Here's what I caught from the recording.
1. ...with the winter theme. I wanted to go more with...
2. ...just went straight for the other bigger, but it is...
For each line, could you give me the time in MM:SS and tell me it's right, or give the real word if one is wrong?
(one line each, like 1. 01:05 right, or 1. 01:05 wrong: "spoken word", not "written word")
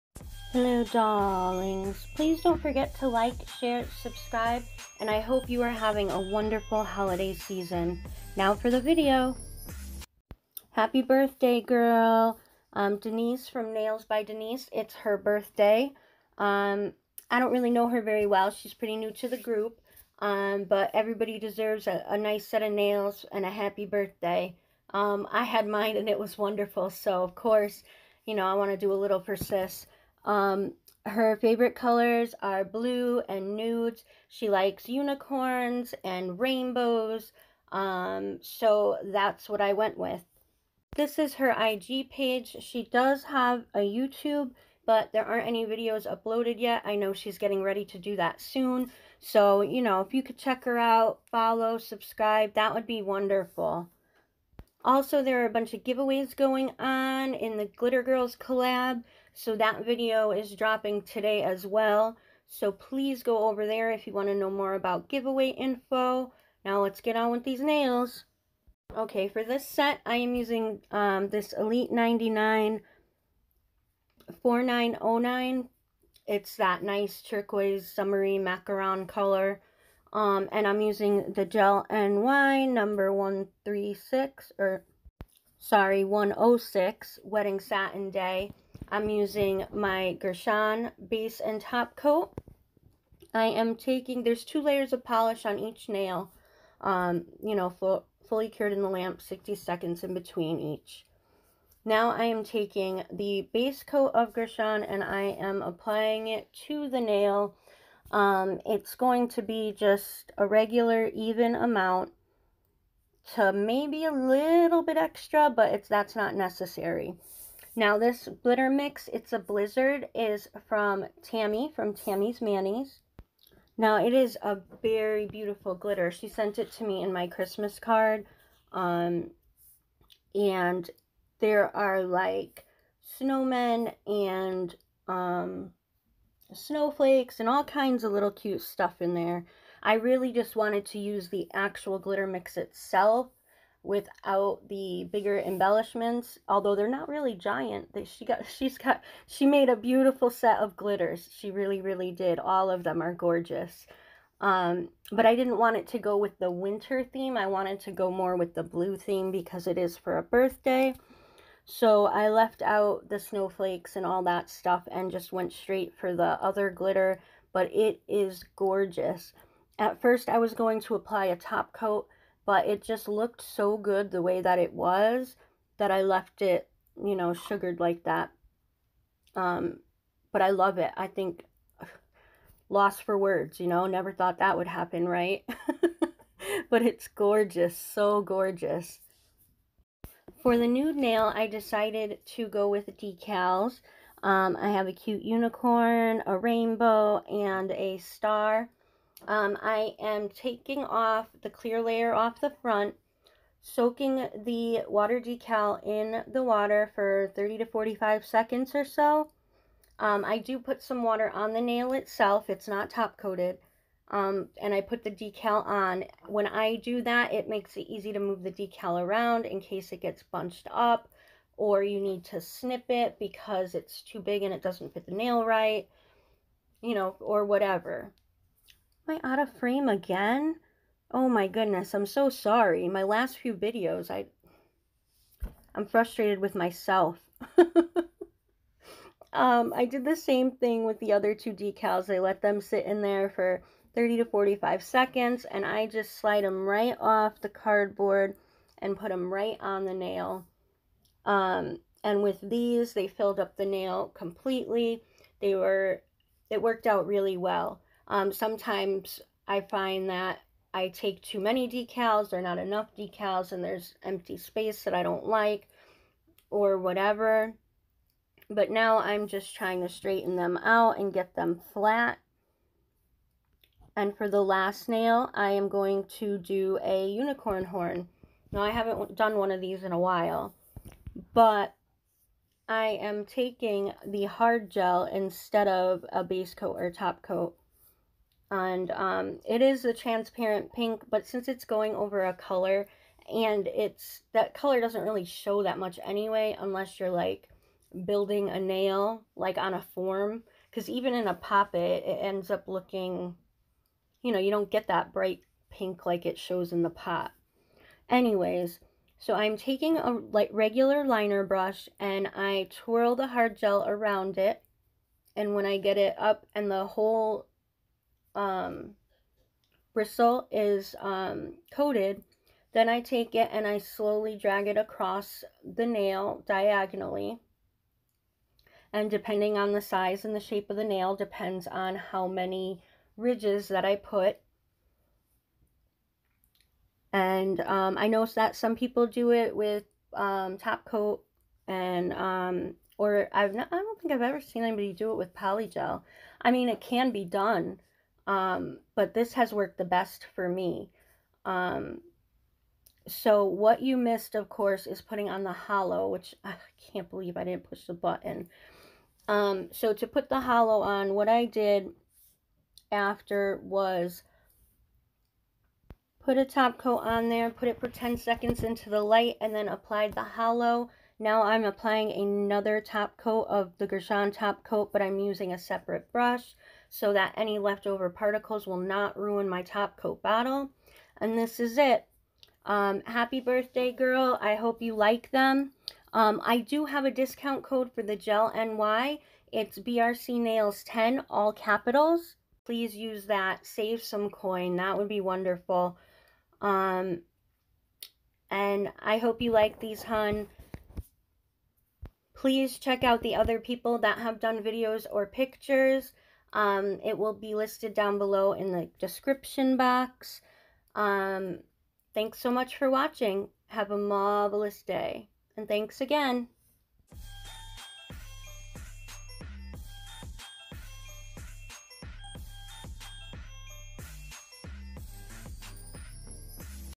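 1. 02:36 right
2. 02:45 wrong: "glitter", not "bigger".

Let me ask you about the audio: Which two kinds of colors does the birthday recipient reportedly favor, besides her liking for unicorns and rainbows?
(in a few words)
Blue and nudes.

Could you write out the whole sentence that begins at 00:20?
Um, but everybody deserves a, a, nice set of nails and a happy birthday.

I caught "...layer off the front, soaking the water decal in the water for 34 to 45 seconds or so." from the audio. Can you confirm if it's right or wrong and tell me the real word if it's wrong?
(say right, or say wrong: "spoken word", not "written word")
wrong: "30", not "34".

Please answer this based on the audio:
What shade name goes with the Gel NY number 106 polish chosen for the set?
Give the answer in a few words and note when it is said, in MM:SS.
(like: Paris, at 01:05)
Wedding Satin Day, at 01:27.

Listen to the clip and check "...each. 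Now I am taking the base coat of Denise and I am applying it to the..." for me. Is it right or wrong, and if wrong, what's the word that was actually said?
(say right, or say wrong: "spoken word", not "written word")
wrong: "Gershon", not "Denise".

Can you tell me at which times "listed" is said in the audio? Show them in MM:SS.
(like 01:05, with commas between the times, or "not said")
06:47.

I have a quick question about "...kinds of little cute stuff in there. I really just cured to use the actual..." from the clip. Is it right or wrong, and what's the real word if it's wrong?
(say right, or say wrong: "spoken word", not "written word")
wrong: "wanted", not "cured".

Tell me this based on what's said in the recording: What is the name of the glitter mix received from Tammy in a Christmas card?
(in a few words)
Blizzard.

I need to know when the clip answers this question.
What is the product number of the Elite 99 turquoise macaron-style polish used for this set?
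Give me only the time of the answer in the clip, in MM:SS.
01:14.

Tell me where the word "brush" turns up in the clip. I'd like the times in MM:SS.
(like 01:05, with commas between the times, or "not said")
05:11, 06:16.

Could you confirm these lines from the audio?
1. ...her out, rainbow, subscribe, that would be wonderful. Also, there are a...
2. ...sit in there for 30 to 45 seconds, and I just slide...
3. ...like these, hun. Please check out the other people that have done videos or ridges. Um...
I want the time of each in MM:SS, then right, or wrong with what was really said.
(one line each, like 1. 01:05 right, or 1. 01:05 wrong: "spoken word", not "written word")
1. 00:50 wrong: "follow", not "rainbow"
2. 04:02 right
3. 06:39 wrong: "pictures", not "ridges".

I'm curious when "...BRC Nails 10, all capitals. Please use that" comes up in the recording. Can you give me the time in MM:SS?
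06:29.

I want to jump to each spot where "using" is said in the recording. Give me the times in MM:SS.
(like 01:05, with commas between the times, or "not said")
01:10, 01:20, 01:29, 06:15.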